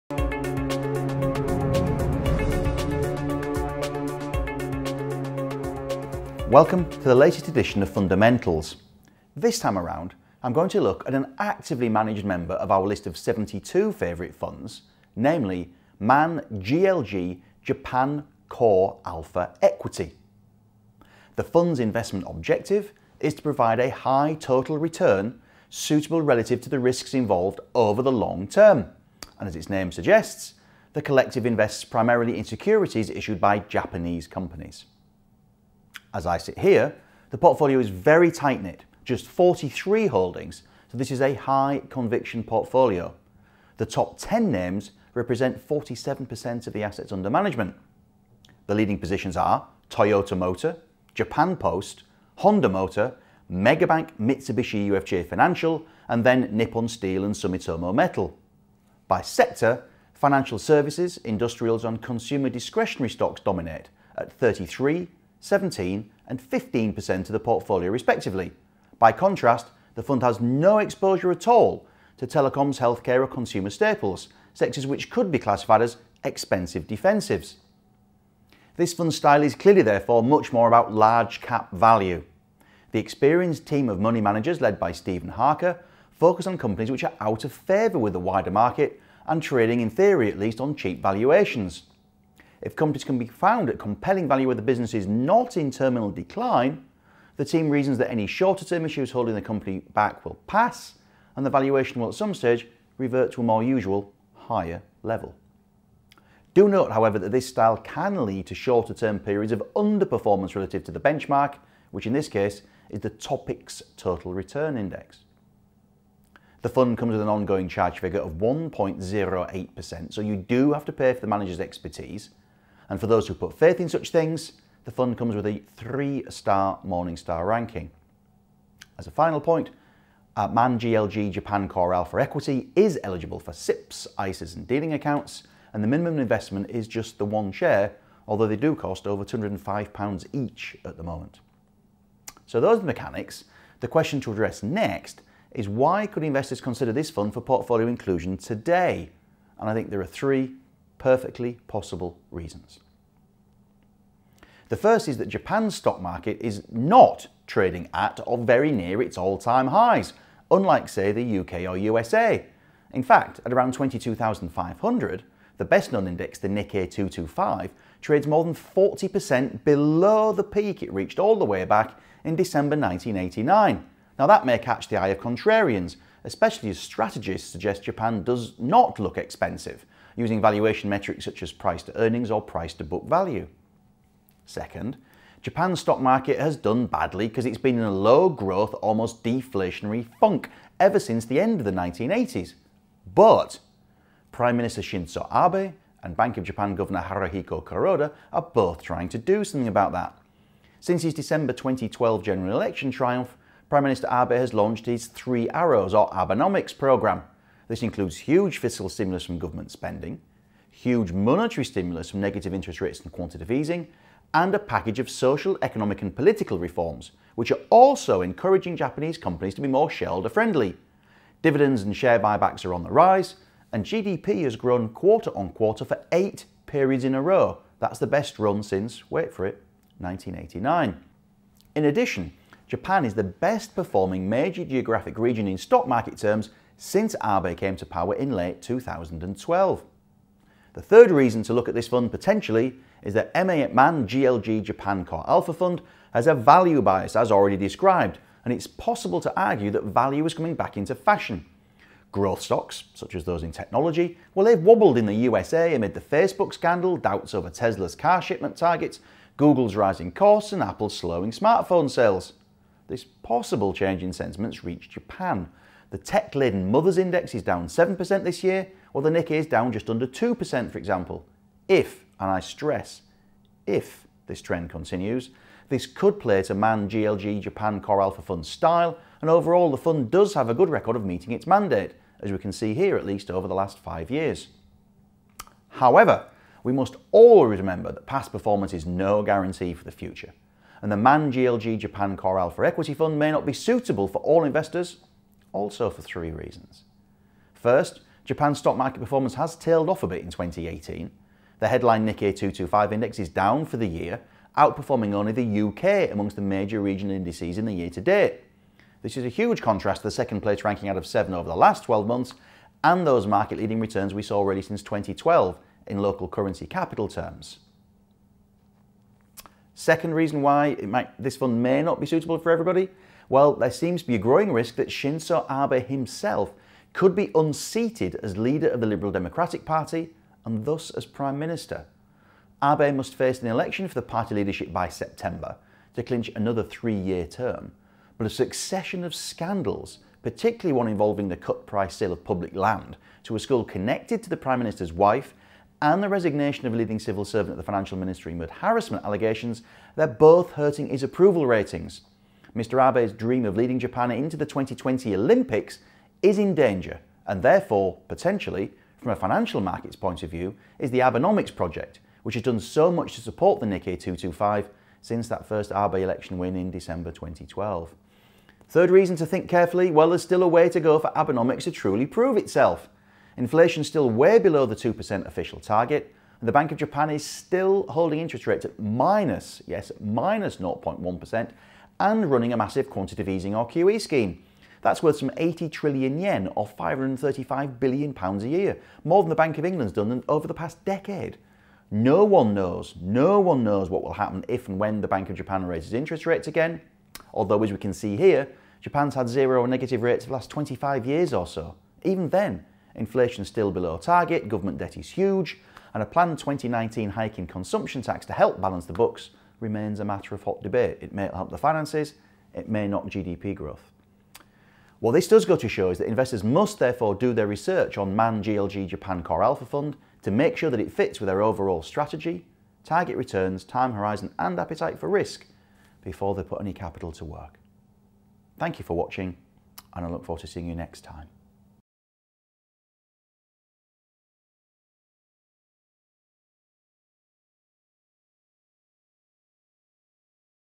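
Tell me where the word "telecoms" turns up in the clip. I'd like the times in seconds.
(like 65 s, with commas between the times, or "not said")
72 s.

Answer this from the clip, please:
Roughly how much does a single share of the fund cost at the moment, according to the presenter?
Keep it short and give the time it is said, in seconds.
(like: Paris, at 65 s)
over £205, at 139 s.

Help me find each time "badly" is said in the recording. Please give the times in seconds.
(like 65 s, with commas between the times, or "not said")
186 s.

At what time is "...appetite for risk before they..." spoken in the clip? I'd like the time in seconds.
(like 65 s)
424 s.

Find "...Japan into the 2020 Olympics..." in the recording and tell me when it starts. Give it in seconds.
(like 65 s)
353 s.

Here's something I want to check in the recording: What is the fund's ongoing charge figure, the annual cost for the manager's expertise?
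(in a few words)
1.08%.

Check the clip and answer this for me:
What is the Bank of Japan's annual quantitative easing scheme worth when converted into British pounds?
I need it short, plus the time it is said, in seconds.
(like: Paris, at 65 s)
535 billion pounds, at 386 s.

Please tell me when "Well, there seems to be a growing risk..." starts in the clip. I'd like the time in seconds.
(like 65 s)
323 s.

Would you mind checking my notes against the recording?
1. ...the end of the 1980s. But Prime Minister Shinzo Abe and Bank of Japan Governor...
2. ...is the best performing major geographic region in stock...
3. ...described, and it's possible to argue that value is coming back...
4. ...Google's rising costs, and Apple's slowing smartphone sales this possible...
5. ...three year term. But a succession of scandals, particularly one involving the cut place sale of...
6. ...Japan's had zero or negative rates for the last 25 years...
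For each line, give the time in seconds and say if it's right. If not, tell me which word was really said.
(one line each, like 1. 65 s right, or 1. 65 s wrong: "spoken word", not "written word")
1. 191 s right
2. 233 s right
3. 247 s right
4. 259 s right
5. 336 s wrong: "price", not "place"
6. 398 s right.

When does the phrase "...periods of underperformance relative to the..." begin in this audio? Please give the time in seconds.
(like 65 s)
109 s.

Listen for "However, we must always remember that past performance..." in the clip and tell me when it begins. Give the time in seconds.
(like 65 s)
285 s.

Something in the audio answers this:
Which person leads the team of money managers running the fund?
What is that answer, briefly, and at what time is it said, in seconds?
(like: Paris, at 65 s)
Stephen Harker, at 84 s.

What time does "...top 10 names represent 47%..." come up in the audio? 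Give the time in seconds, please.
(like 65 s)
43 s.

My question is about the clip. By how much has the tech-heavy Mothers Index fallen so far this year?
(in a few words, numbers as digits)
7%.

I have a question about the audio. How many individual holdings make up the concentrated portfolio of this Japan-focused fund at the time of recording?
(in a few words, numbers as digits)
43.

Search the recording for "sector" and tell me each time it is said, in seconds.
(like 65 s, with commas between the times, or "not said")
59 s, 74 s.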